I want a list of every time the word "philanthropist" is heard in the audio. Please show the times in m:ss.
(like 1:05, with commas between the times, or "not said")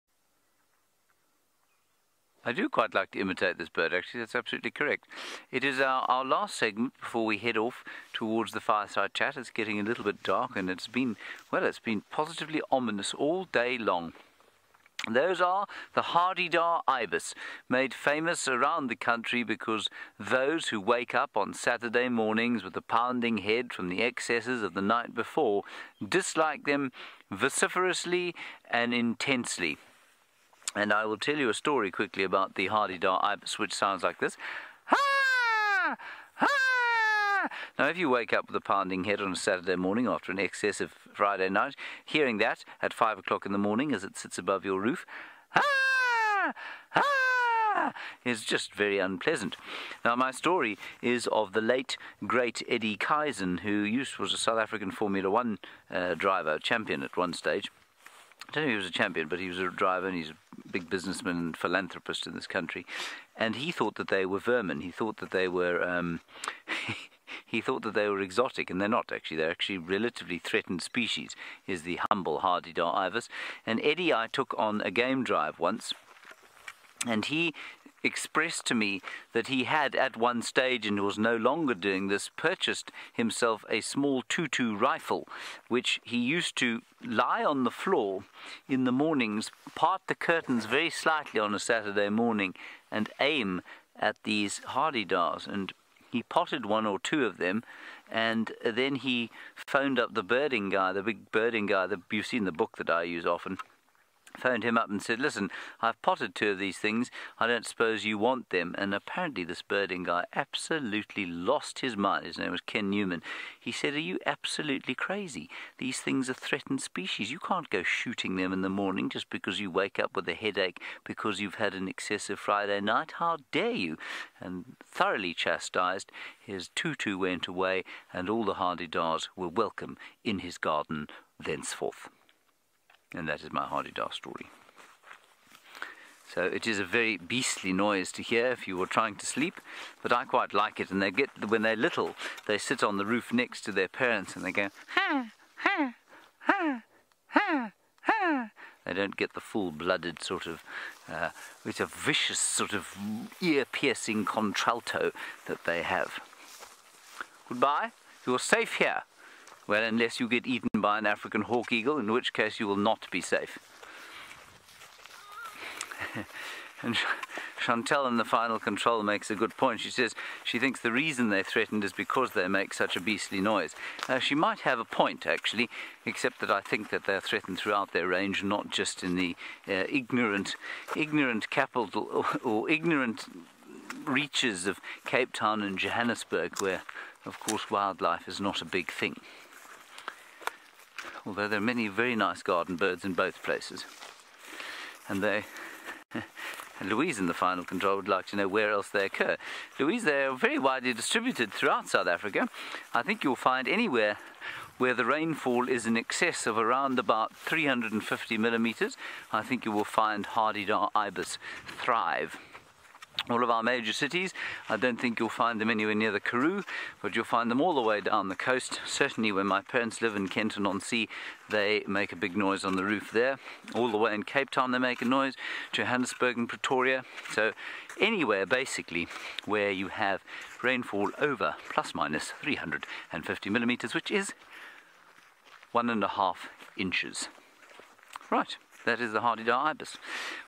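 1:01.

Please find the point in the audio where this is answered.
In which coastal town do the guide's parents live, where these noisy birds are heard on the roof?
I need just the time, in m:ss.
3:40.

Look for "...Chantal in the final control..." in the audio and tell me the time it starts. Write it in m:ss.
2:47.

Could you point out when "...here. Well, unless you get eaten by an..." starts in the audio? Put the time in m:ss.
2:38.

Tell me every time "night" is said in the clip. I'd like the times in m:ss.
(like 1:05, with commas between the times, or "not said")
0:24, 0:41, 2:02.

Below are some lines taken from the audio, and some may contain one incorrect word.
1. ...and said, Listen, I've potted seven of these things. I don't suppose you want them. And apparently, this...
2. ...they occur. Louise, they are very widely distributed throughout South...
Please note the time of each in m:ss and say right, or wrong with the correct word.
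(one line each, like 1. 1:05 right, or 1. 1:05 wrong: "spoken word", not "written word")
1. 1:44 wrong: "two", not "seven"
2. 3:18 right.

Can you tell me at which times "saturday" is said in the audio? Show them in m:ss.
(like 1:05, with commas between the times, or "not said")
0:21, 0:39, 1:31.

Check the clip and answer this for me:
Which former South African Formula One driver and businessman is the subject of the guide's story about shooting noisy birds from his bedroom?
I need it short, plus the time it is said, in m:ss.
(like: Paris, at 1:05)
Eddie Keizan, at 0:52.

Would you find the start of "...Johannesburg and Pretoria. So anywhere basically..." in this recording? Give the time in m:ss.
3:45.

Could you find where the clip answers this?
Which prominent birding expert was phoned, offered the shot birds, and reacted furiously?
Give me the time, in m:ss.
1:52.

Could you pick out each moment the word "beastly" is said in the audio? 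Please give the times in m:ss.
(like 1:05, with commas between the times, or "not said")
2:17, 2:52.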